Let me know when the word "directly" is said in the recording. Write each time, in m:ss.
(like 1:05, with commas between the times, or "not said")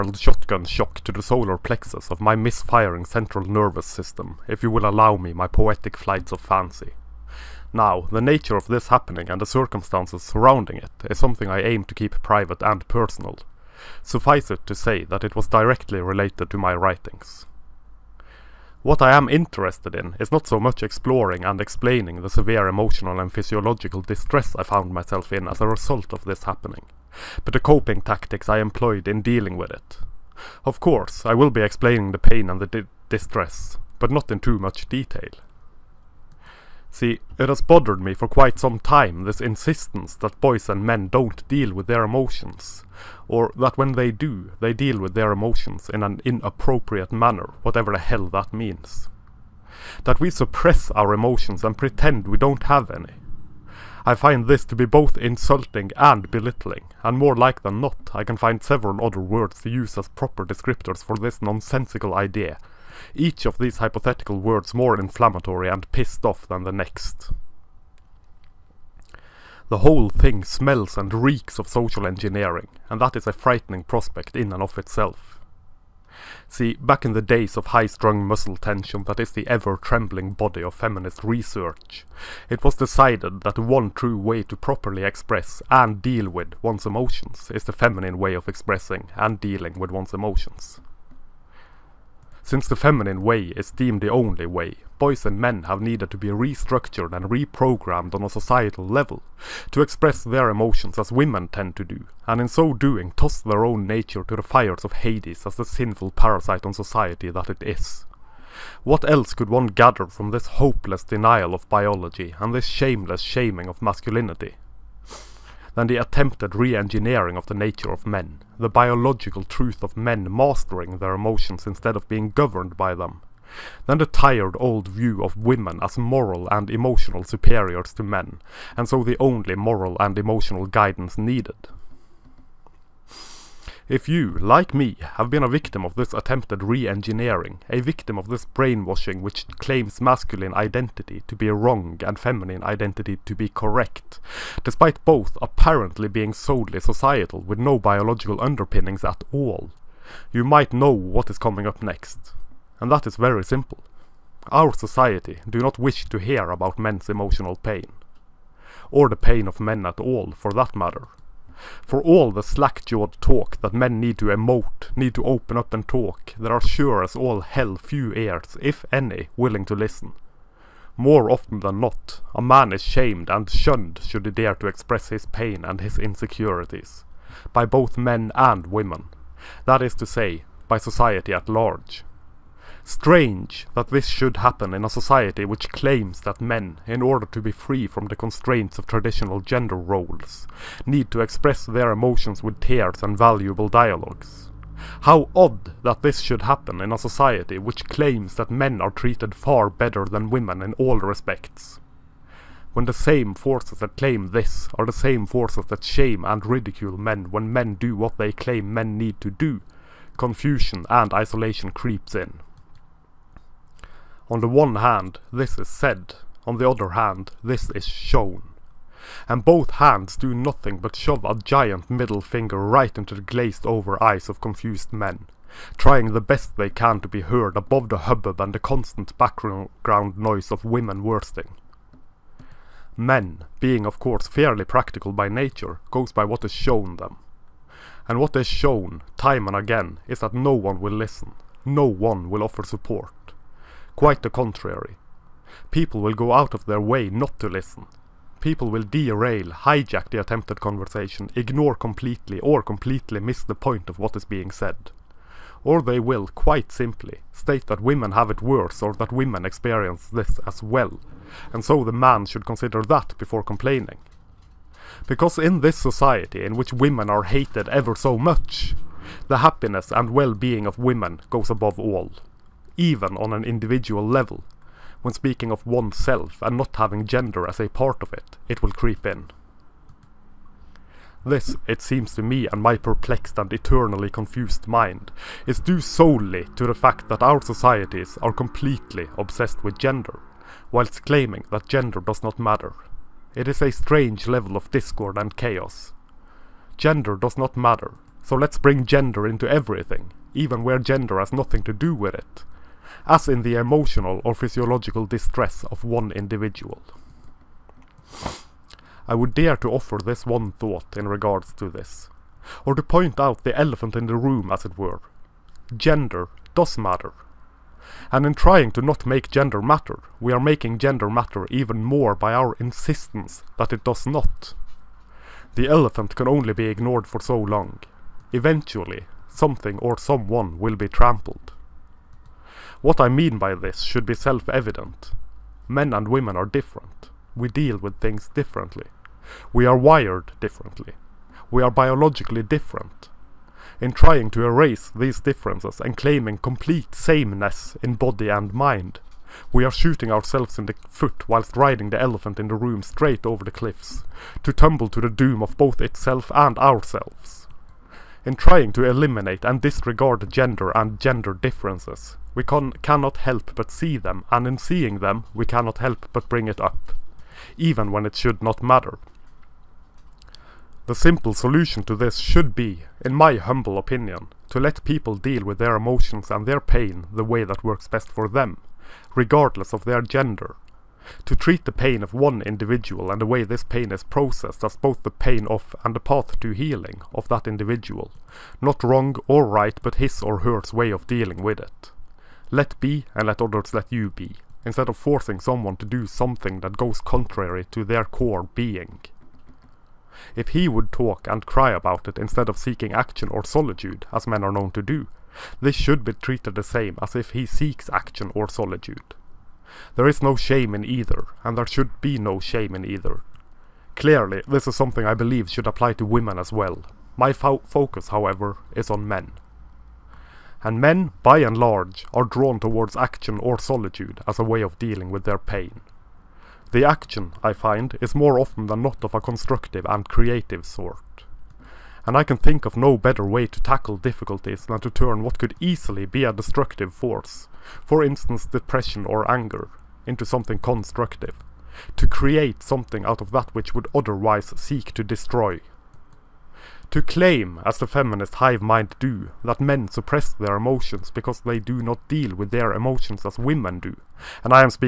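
0:15.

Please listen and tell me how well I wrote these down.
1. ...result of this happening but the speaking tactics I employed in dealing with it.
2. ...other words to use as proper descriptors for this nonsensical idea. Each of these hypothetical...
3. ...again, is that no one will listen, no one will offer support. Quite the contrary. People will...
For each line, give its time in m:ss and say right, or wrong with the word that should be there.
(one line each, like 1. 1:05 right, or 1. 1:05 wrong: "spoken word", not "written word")
1. 0:25 wrong: "coping", not "speaking"
2. 0:59 right
3. 3:59 right.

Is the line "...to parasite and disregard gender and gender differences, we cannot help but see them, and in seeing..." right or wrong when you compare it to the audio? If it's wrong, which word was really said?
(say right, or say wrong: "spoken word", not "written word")
wrong: "eliminate", not "parasite".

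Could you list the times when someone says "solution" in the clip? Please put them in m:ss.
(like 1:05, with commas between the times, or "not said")
6:11.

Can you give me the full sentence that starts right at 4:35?
When speaking of oneself and not having gender as a part of it, it will creep in.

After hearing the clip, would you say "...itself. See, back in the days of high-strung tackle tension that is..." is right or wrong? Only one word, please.
wrong.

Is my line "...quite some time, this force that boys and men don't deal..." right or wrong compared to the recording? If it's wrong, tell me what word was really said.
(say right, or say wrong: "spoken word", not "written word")
wrong: "insistence", not "force".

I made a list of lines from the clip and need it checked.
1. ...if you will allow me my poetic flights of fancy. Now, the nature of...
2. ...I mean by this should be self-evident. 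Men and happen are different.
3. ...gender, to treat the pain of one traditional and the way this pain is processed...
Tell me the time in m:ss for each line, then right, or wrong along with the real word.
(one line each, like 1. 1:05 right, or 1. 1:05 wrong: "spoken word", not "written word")
1. 0:04 right
2. 5:32 wrong: "women", not "happen"
3. 6:20 wrong: "individual", not "traditional".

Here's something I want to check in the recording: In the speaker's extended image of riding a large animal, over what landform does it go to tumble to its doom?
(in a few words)
cliffs.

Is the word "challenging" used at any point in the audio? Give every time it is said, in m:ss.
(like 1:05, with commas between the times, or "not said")
not said.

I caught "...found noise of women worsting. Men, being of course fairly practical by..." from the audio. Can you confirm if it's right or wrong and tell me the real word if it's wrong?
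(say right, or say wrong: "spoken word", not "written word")
wrong: "background", not "found".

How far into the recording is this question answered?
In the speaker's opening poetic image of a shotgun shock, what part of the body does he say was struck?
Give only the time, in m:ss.
0:01.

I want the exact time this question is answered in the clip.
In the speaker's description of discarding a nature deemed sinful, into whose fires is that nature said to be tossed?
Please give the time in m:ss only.
1:44.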